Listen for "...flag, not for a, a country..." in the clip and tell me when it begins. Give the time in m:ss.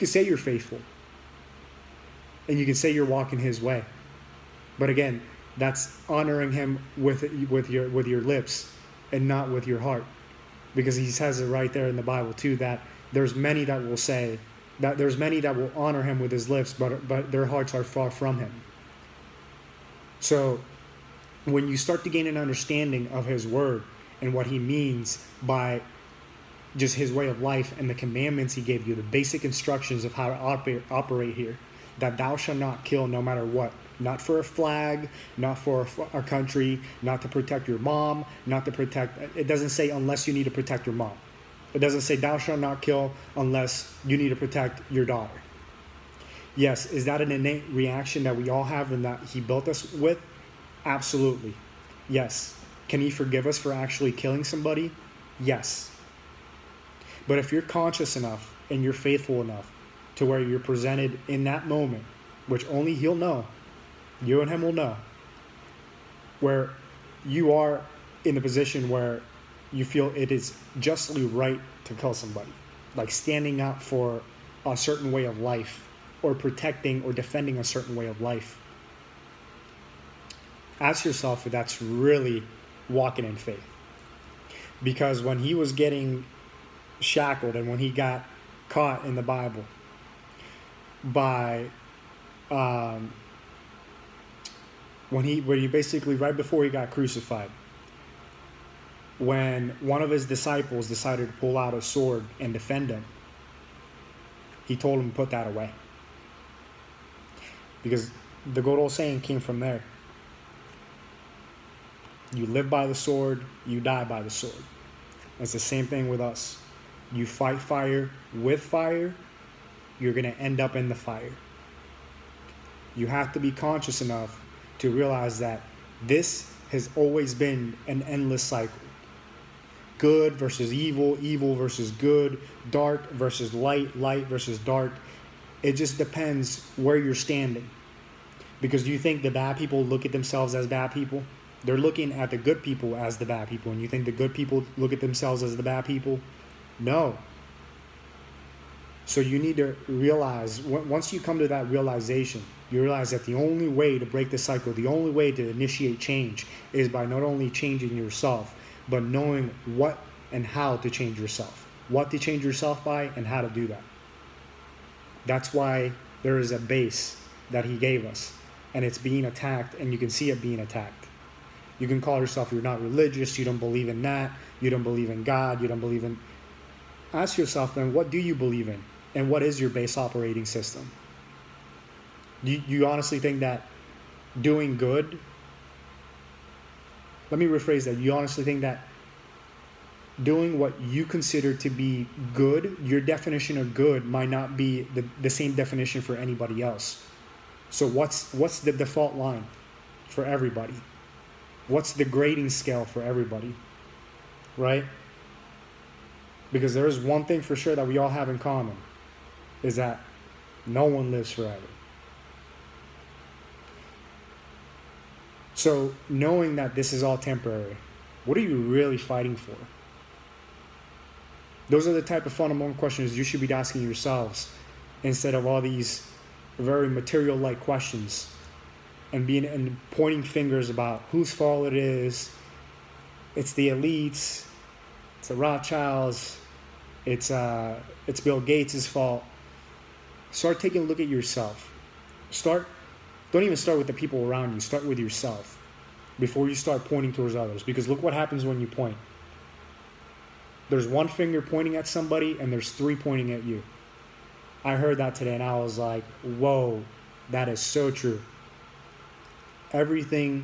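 0:34.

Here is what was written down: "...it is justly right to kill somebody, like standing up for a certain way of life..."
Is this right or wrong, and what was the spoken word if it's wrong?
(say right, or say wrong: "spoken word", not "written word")
right.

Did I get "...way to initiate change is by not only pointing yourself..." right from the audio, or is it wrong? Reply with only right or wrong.
wrong.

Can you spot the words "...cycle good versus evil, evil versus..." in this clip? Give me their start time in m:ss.
2:08.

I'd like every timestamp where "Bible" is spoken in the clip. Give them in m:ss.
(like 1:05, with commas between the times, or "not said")
0:12, 1:29.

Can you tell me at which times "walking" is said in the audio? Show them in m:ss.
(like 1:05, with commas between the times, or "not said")
0:03, 1:22.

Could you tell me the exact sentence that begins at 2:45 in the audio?
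That's why there is a base that he gave us, and it's being attacked, and you can see it being attacked.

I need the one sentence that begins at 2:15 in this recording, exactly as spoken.
It just depends where you're standing.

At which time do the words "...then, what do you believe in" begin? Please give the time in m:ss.
2:57.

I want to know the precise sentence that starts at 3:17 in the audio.
So what's what's the default line for everybody?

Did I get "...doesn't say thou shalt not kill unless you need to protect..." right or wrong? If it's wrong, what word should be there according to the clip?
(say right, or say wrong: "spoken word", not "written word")
right.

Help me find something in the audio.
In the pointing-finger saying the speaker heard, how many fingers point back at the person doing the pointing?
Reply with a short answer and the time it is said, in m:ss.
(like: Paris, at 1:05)
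3, at 4:12.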